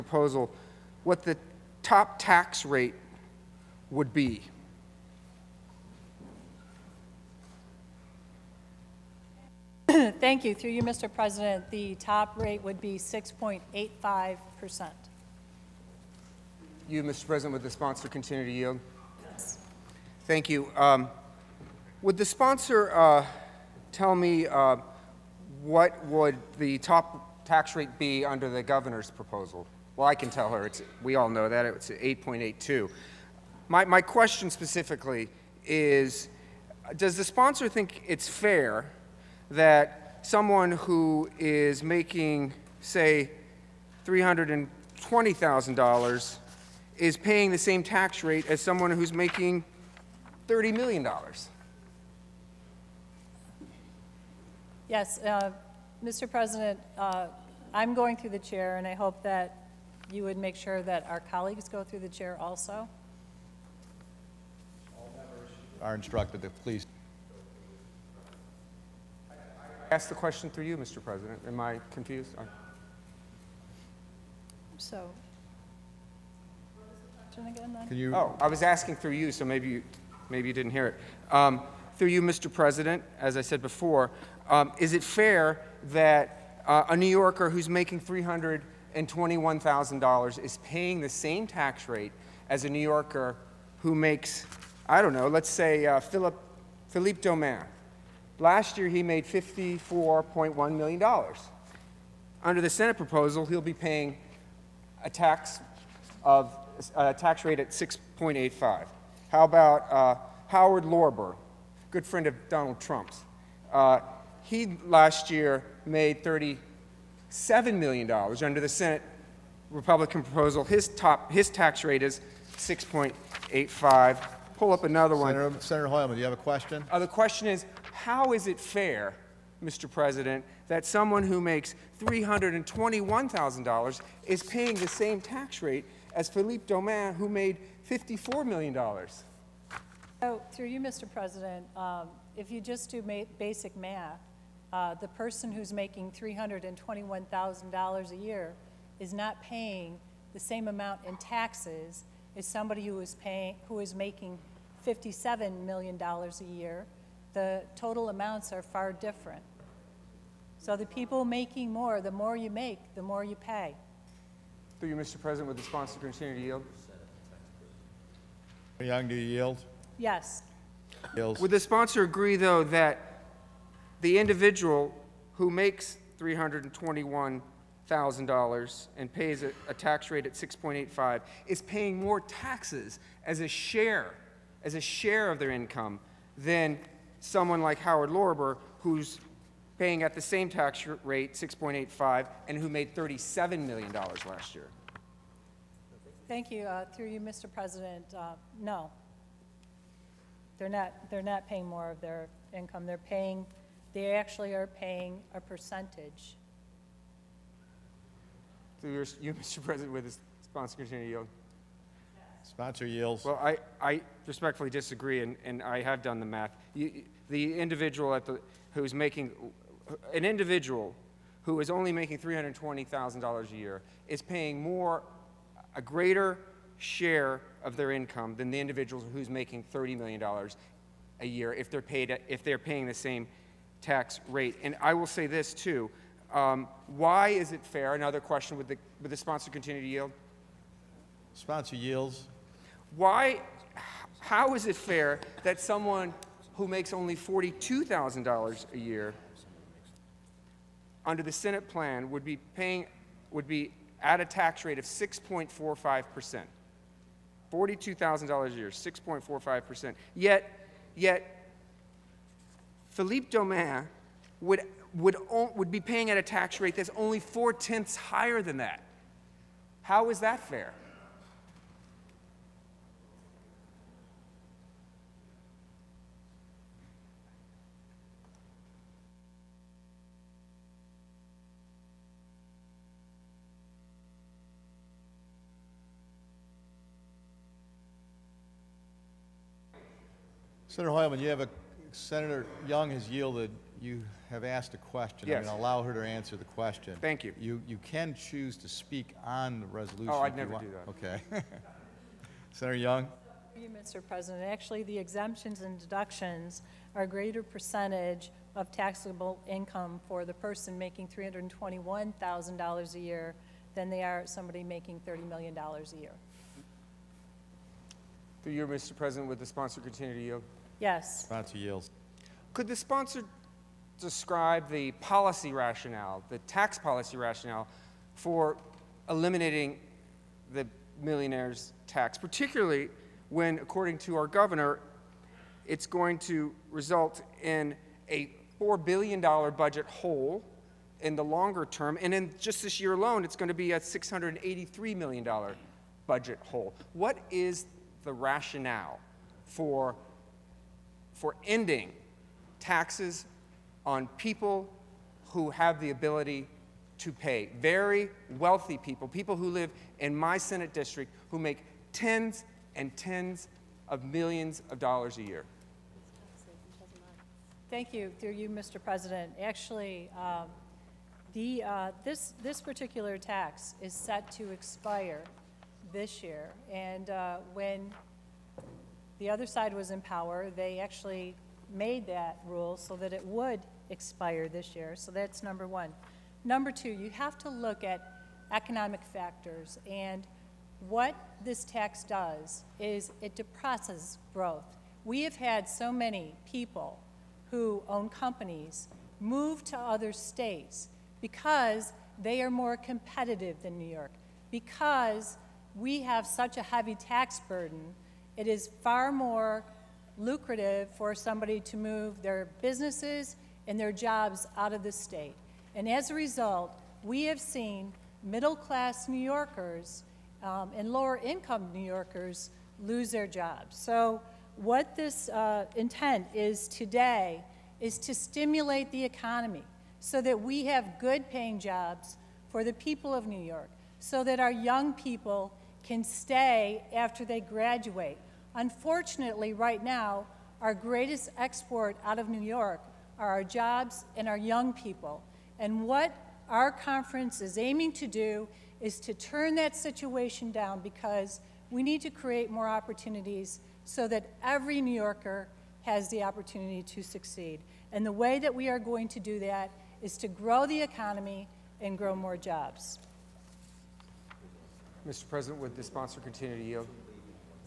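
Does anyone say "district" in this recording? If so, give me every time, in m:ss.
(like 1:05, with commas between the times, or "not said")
6:00.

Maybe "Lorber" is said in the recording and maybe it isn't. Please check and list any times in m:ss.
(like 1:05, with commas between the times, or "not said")
1:50, 3:08.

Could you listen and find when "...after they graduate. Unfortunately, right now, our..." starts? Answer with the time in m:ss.
7:16.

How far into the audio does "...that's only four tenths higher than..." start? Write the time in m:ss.
4:26.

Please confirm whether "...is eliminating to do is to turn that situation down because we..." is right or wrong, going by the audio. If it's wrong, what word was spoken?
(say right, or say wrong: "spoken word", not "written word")
wrong: "aiming", not "eliminating".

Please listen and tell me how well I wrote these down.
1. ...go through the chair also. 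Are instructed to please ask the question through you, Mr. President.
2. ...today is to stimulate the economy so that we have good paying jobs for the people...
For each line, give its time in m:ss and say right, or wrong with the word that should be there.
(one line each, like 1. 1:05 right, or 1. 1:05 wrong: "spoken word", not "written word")
1. 1:01 right
2. 7:06 right.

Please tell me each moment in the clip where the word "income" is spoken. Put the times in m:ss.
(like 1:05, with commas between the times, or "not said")
3:05, 3:22, 3:47, 5:09, 7:01.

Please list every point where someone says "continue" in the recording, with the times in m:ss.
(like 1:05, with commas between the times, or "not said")
0:18, 2:45, 3:59, 5:19, 7:46.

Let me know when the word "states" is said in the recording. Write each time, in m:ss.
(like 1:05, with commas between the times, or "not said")
6:40, 6:54.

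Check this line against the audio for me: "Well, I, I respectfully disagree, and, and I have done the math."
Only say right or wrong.
right.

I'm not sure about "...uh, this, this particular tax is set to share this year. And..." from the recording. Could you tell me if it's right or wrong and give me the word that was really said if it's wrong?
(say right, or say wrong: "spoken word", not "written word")
wrong: "expire", not "share".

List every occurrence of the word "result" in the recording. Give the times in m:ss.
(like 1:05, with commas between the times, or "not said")
5:36, 6:56.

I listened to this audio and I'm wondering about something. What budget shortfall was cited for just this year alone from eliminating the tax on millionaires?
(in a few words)
$683 million.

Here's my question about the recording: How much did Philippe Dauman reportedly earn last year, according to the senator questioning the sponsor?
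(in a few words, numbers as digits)
$54.1 million.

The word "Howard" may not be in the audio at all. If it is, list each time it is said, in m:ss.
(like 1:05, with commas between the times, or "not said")
1:50, 3:07.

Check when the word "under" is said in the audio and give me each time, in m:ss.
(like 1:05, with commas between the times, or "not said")
0:28, 1:42, 1:58, 4:11.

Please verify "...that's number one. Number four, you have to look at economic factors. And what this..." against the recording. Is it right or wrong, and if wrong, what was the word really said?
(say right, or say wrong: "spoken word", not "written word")
wrong: "two", not "four".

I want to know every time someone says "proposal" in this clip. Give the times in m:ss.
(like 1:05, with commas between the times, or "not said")
0:29, 1:42, 2:00.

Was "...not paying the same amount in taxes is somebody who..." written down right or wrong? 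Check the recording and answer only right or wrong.
right.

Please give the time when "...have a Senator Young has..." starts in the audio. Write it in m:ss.
4:51.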